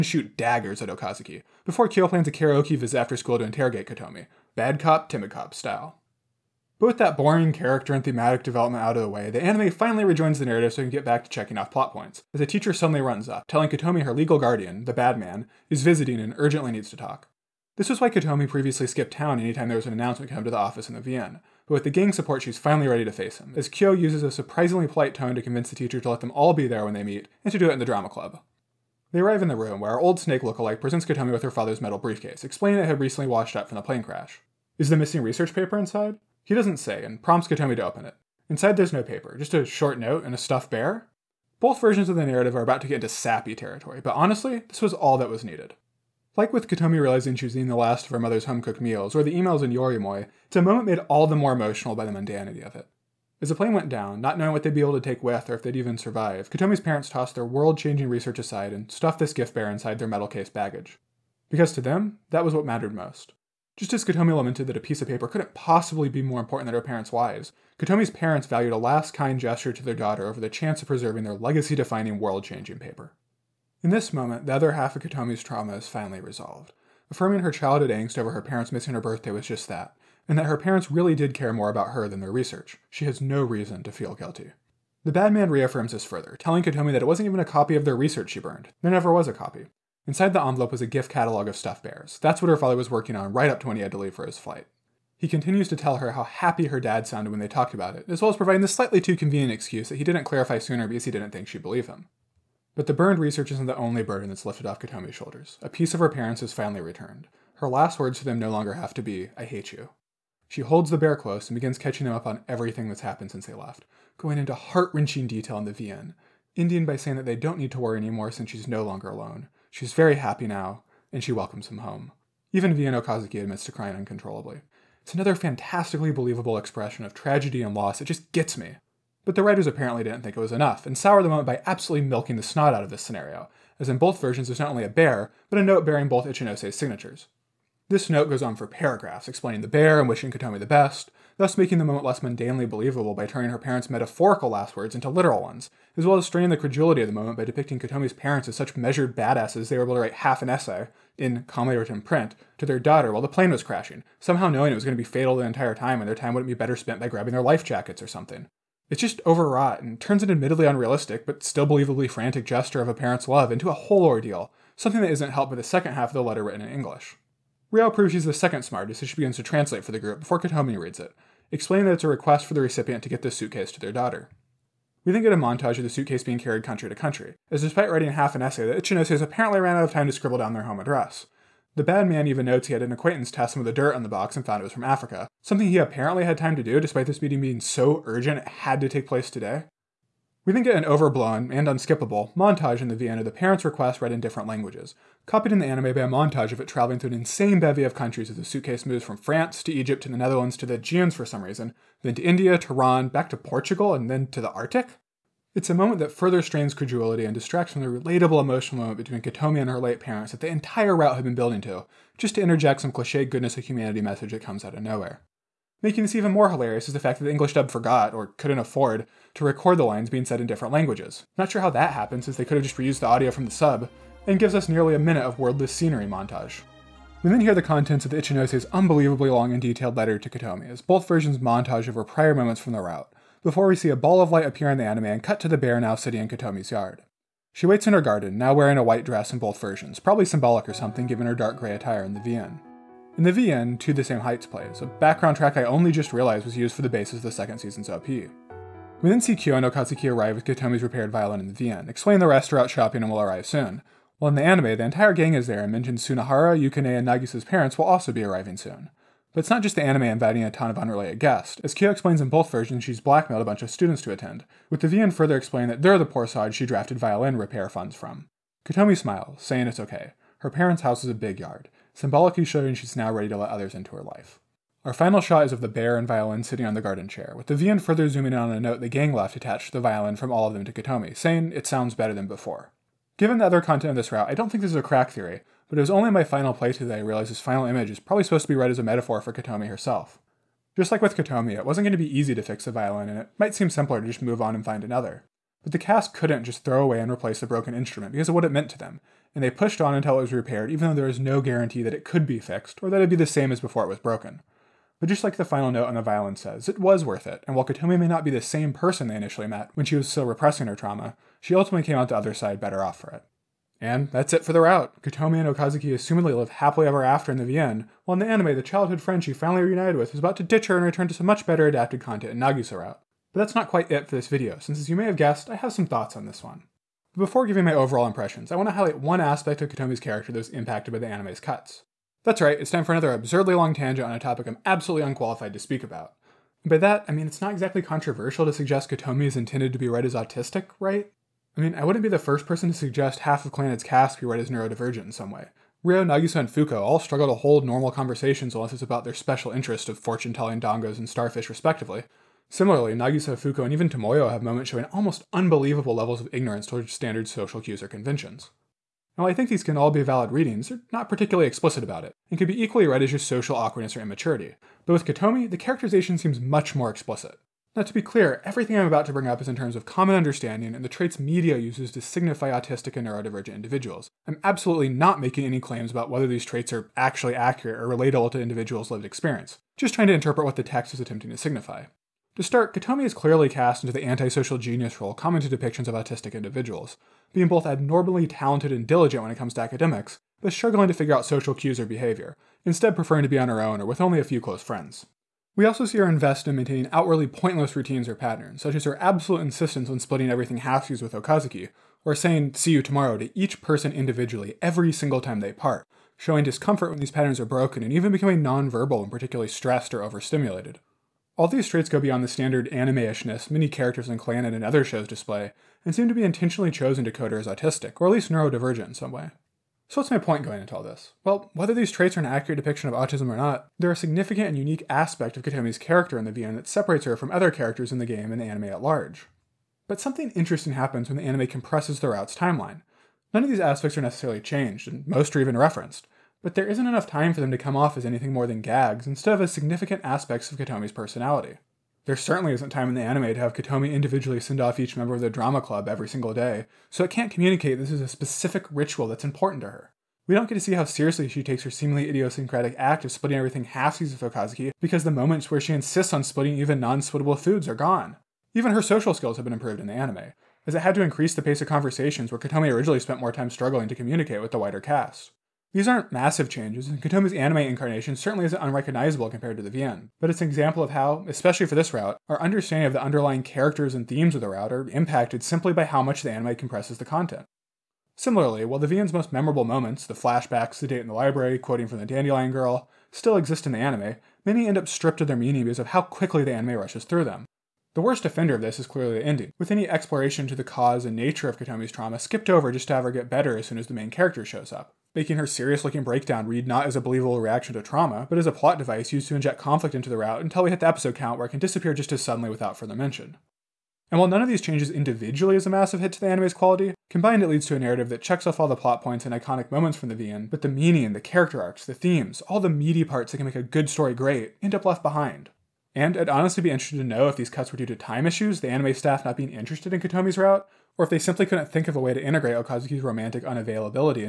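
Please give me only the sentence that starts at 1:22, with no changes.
She has no reason to feel guilty.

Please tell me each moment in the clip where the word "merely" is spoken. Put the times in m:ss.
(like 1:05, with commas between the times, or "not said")
not said.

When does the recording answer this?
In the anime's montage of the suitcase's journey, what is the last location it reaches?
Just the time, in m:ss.
3:24.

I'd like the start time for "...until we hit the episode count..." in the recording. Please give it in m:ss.
8:20.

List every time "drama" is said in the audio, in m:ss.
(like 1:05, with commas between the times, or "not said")
0:27, 7:25.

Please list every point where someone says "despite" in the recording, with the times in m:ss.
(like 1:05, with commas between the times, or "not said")
2:57, 3:06.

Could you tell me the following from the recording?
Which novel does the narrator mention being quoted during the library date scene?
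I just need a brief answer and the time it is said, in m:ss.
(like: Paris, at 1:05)
The Dandelion Girl, at 8:02.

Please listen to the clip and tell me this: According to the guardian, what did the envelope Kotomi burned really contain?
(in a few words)
A gift catalog of stuffed bears.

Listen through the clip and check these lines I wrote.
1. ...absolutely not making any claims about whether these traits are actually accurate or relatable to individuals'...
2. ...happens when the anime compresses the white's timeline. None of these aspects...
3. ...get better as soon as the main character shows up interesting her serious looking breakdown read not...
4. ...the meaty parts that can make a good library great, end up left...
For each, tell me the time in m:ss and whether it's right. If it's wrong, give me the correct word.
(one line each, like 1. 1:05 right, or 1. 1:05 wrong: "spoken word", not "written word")
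1. 6:14 right
2. 7:10 wrong: "route", not "white"
3. 8:13 wrong: "making", not "interesting"
4. 8:32 wrong: "story", not "library".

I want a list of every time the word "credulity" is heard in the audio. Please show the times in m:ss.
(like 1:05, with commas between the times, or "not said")
2:26, 3:26.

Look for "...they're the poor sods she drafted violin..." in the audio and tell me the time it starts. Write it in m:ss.
4:25.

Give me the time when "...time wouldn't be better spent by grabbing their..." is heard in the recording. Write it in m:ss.
2:36.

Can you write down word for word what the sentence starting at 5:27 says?
But before giving my overall impressions, I want to highlight one aspect of Kotomi's character that was impacted by the anime's cuts.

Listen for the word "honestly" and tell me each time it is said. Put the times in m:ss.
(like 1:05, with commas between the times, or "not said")
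0:44, 8:36.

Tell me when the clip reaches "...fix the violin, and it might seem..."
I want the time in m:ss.
4:52.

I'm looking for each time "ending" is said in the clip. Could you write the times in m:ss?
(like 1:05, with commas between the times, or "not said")
1:56, 8:09.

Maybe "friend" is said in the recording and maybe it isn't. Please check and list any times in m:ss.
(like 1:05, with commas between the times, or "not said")
5:19, 6:34.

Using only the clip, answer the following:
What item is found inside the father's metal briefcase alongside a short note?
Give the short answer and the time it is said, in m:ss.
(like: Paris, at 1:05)
A stuffed bear, at 0:40.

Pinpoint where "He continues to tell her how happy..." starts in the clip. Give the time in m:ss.
1:35.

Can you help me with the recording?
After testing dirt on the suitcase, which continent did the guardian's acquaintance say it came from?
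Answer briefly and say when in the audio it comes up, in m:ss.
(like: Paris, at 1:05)
Africa, at 3:04.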